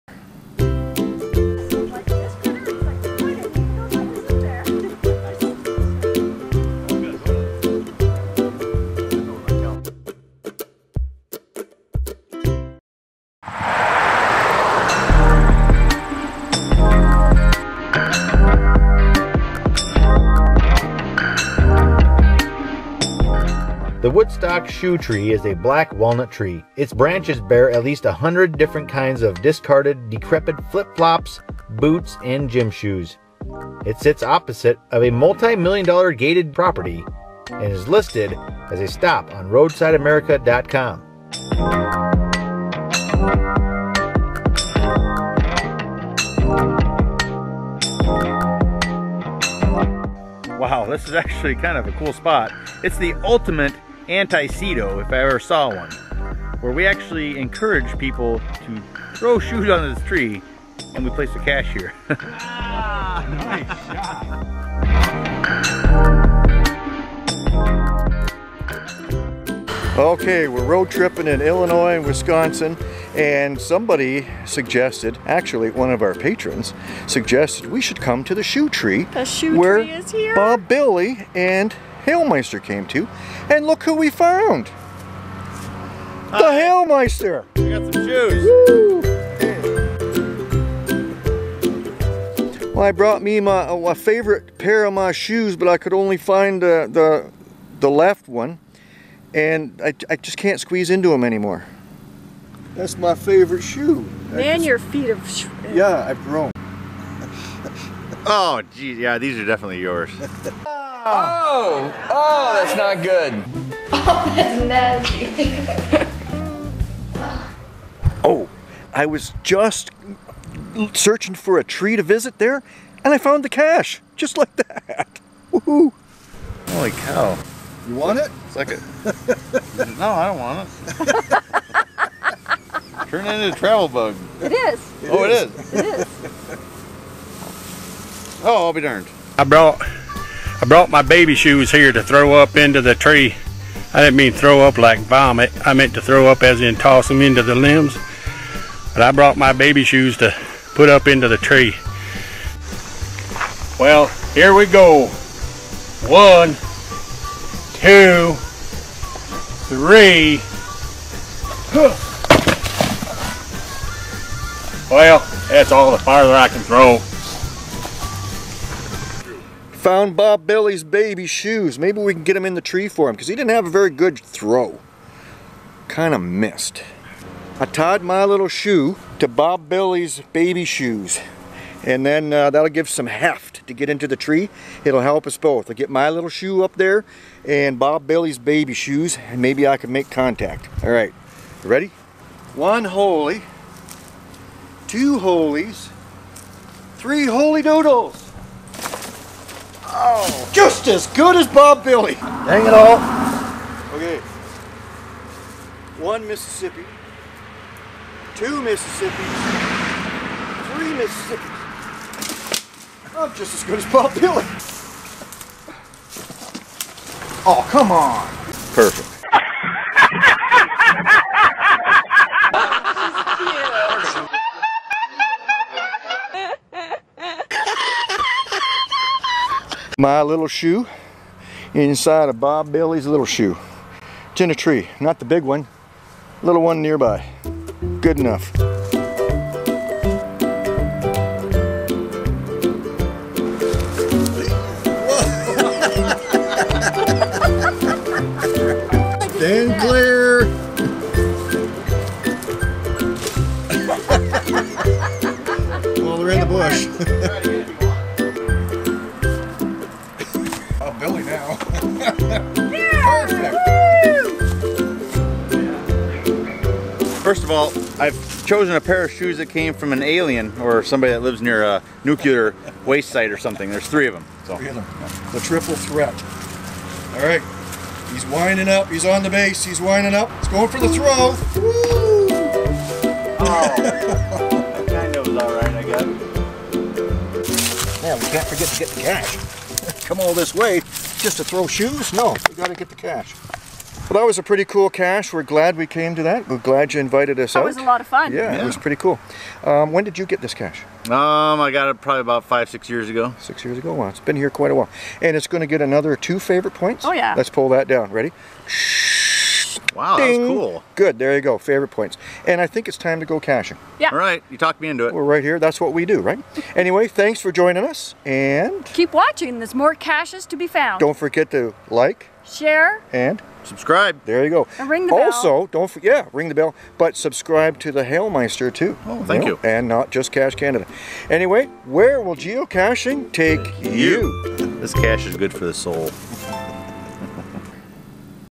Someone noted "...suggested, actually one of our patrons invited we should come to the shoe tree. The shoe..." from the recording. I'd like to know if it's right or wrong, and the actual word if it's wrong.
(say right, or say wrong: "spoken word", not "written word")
wrong: "suggested", not "invited".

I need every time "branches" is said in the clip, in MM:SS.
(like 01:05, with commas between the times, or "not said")
00:26.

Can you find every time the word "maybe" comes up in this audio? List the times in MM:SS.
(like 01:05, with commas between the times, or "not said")
02:51, 03:09.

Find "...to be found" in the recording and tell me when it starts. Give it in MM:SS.
05:20.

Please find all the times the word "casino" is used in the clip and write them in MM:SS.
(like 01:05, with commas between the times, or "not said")
not said.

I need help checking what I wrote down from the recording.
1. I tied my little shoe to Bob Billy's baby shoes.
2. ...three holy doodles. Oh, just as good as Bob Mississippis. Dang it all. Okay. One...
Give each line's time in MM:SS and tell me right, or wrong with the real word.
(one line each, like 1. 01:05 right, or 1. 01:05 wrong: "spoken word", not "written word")
1. 02:57 right
2. 03:16 wrong: "Billy", not "Mississippis".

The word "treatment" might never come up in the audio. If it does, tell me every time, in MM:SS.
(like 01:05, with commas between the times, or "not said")
not said.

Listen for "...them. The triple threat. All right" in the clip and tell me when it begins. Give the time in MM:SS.
04:34.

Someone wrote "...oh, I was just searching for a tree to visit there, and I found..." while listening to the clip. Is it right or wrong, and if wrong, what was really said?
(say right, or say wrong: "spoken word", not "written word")
right.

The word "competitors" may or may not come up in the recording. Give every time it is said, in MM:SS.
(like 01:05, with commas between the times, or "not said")
not said.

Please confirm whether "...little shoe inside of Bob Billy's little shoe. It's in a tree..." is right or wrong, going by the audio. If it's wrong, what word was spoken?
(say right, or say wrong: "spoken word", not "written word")
right.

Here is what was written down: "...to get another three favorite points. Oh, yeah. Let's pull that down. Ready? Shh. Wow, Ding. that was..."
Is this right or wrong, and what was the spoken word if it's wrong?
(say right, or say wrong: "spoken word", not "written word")
wrong: "two", not "three".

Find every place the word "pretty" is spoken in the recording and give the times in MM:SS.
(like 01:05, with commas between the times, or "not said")
04:54, 04:58.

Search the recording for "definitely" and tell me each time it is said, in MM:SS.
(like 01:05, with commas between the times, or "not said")
01:49.